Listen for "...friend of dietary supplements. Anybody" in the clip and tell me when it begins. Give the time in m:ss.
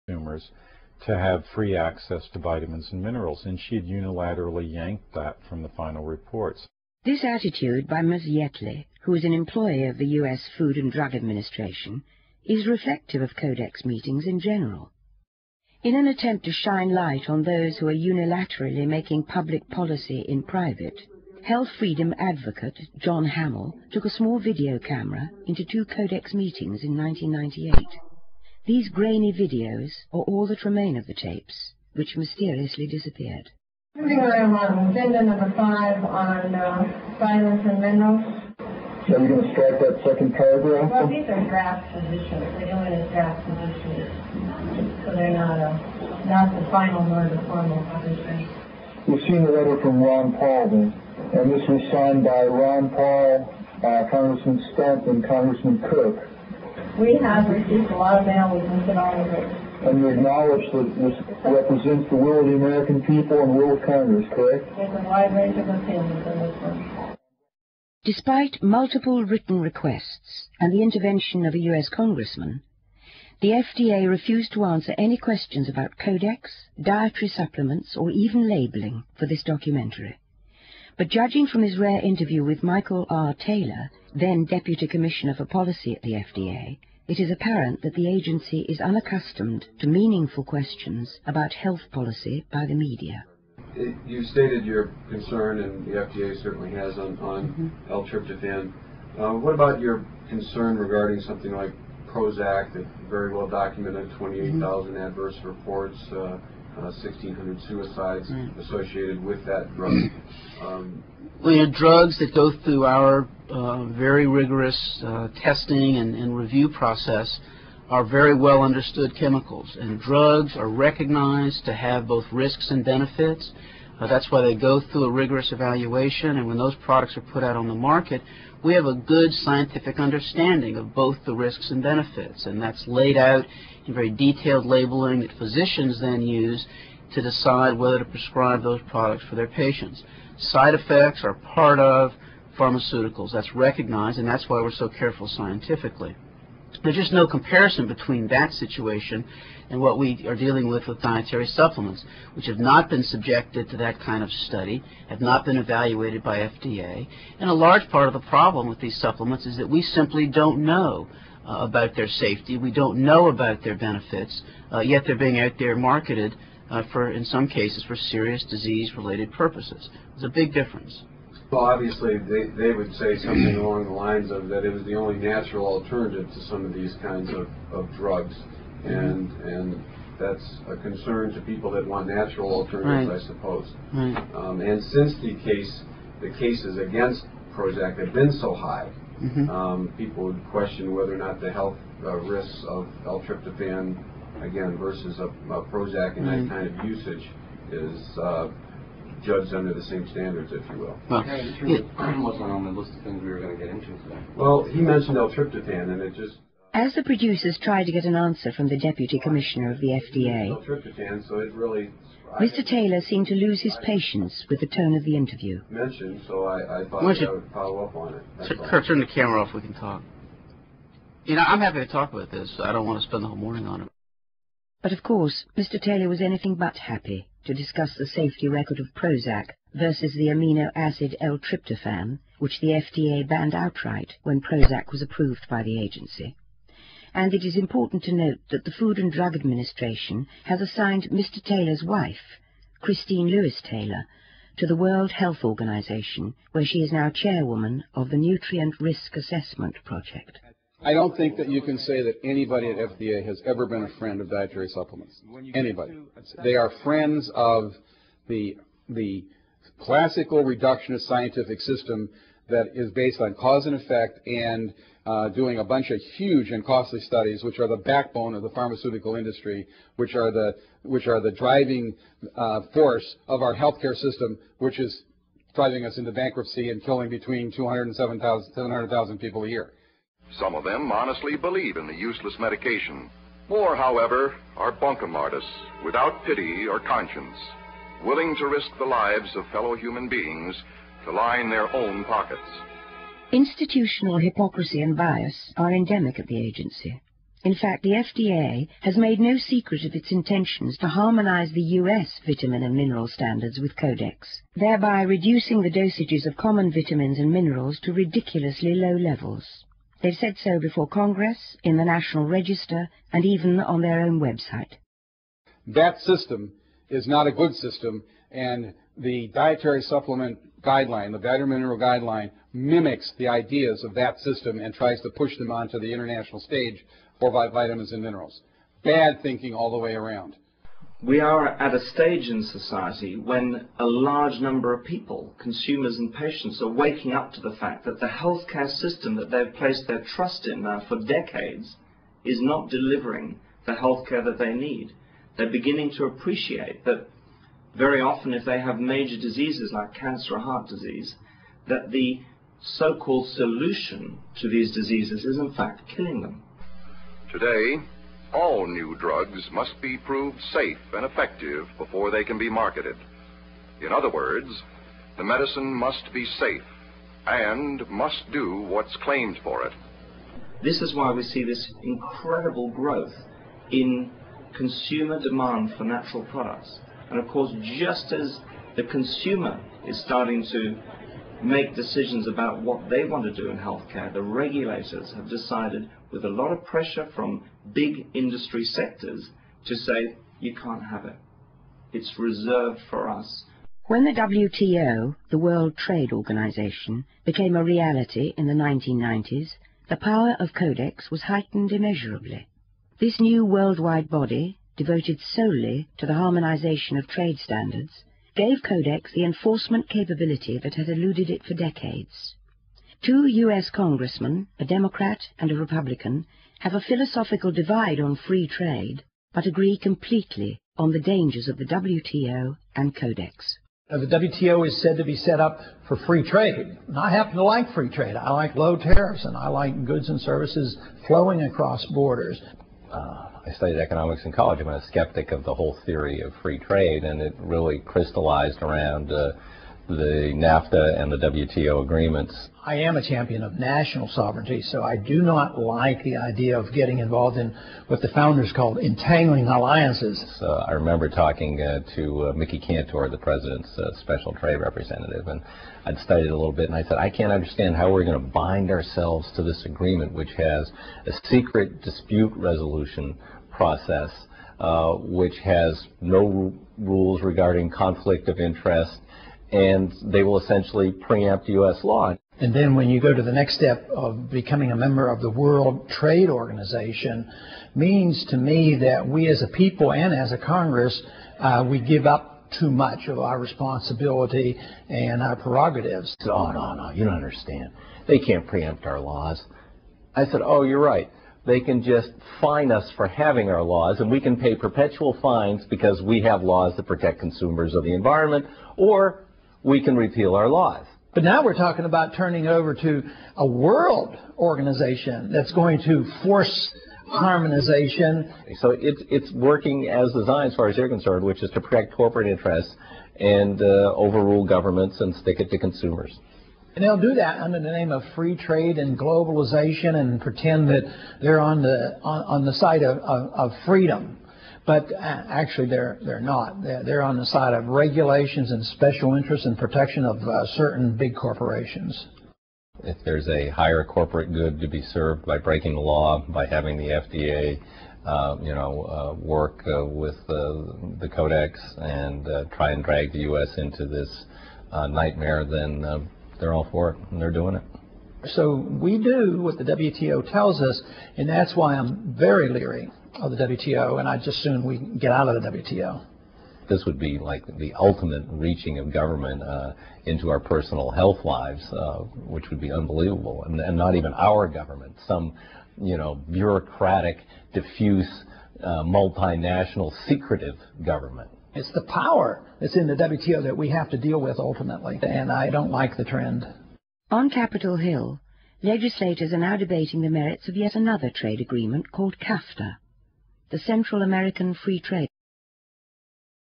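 4:13.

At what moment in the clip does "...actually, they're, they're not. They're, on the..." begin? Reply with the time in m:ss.
8:44.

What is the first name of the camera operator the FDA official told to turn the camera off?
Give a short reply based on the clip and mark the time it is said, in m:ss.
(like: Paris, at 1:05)
Kurt, at 3:38.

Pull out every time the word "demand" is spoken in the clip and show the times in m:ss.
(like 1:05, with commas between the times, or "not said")
6:15.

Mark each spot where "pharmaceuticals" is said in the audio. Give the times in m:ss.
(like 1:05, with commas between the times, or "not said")
2:22, 4:28.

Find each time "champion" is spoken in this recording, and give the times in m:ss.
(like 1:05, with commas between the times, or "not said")
7:23.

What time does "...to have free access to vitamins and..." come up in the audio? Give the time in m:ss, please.
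0:01.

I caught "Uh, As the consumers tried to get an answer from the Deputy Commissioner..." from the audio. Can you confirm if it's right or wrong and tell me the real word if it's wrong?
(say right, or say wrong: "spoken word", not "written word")
wrong: "producers", not "consumers".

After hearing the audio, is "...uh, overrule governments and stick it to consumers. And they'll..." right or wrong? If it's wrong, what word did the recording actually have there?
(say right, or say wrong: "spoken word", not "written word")
right.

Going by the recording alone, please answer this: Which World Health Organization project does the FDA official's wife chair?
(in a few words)
Nutrient Risk Assessment Project.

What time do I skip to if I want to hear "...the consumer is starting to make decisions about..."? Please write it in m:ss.
6:18.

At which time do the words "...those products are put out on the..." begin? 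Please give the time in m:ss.
2:06.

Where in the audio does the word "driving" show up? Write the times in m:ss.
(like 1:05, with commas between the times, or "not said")
4:31, 4:35.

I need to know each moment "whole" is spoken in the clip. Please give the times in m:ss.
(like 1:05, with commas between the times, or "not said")
3:43, 7:15.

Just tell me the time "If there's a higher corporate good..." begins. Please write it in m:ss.
8:52.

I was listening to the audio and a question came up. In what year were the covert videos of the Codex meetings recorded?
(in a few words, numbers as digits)
1998.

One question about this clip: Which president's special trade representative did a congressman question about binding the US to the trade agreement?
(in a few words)
Mickey Kantor.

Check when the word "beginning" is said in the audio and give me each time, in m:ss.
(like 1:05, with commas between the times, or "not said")
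5:45.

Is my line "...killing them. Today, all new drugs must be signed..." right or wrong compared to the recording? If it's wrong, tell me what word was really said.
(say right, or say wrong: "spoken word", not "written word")
wrong: "proved", not "signed".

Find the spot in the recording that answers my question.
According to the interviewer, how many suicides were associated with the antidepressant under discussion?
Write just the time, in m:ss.
1:46.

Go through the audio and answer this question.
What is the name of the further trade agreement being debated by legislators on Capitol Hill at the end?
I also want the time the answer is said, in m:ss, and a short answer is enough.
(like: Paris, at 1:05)
CAFTA, at 9:42.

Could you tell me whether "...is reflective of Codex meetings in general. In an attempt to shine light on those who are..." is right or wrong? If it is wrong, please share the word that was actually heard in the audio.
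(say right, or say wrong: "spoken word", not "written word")
right.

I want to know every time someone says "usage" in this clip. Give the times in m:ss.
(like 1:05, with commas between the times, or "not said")
3:16.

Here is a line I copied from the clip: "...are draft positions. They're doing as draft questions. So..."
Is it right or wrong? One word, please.
wrong.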